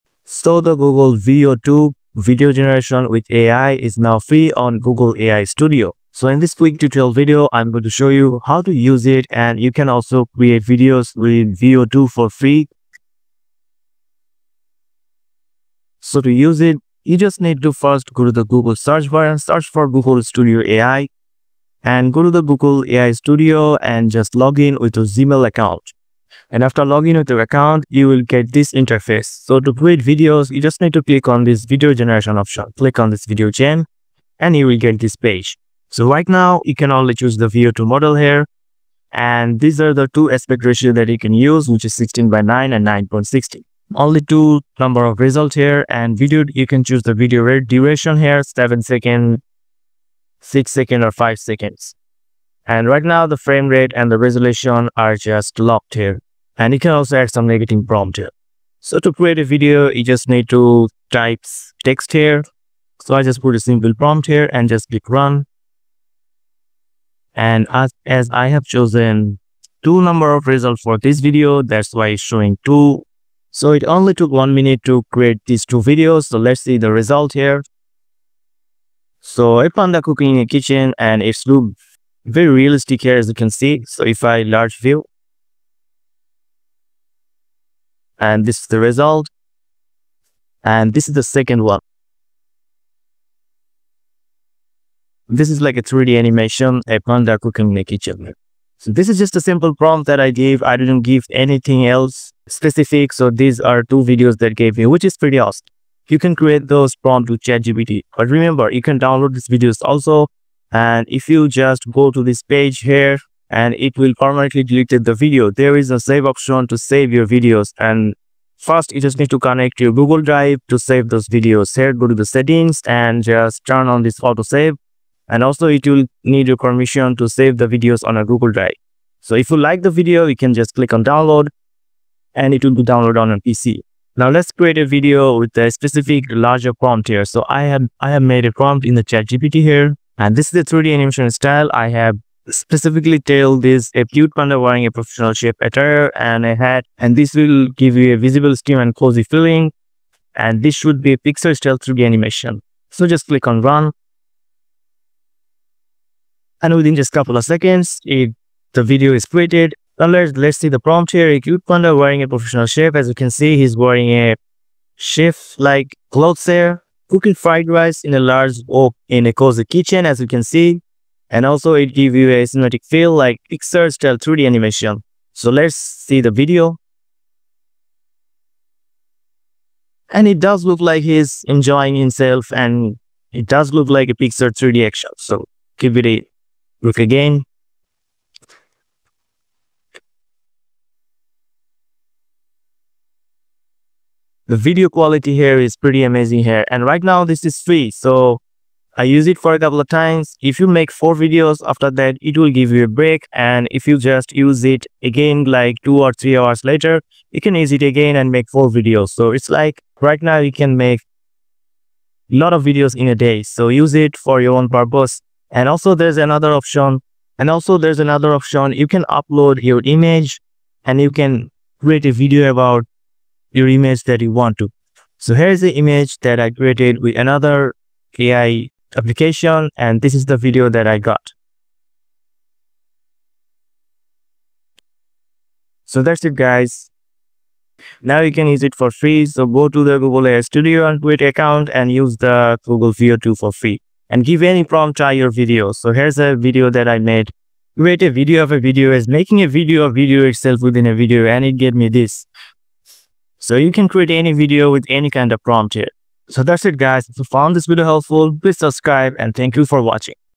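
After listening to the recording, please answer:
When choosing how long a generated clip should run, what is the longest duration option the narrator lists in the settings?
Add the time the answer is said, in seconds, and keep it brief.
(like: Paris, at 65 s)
7 seconds, at 48 s.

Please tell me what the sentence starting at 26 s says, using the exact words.
And after logging into your account, you will get this interface.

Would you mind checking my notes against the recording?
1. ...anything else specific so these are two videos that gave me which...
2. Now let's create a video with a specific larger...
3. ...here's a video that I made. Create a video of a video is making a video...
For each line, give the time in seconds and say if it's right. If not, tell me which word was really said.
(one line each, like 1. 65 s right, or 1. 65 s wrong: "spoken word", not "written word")
1. 101 s right
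2. 134 s right
3. 245 s right.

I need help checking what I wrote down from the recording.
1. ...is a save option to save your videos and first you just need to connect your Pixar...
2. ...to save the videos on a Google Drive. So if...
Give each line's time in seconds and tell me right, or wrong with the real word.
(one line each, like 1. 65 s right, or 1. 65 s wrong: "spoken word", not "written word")
1. 115 s wrong: "Google", not "Pixar"
2. 127 s right.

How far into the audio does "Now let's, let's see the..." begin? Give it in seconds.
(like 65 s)
159 s.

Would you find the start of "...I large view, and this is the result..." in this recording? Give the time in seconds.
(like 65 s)
84 s.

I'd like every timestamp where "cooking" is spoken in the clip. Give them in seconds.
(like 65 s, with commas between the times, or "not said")
80 s, 97 s, 167 s.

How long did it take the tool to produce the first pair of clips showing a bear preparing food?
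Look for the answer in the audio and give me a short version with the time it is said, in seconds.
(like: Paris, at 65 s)
1 minute, at 74 s.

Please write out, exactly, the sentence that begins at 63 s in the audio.
So I just put a simple prompt here and just click run.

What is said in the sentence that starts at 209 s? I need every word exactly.
So it's like right now you can make a lot of videos in a day.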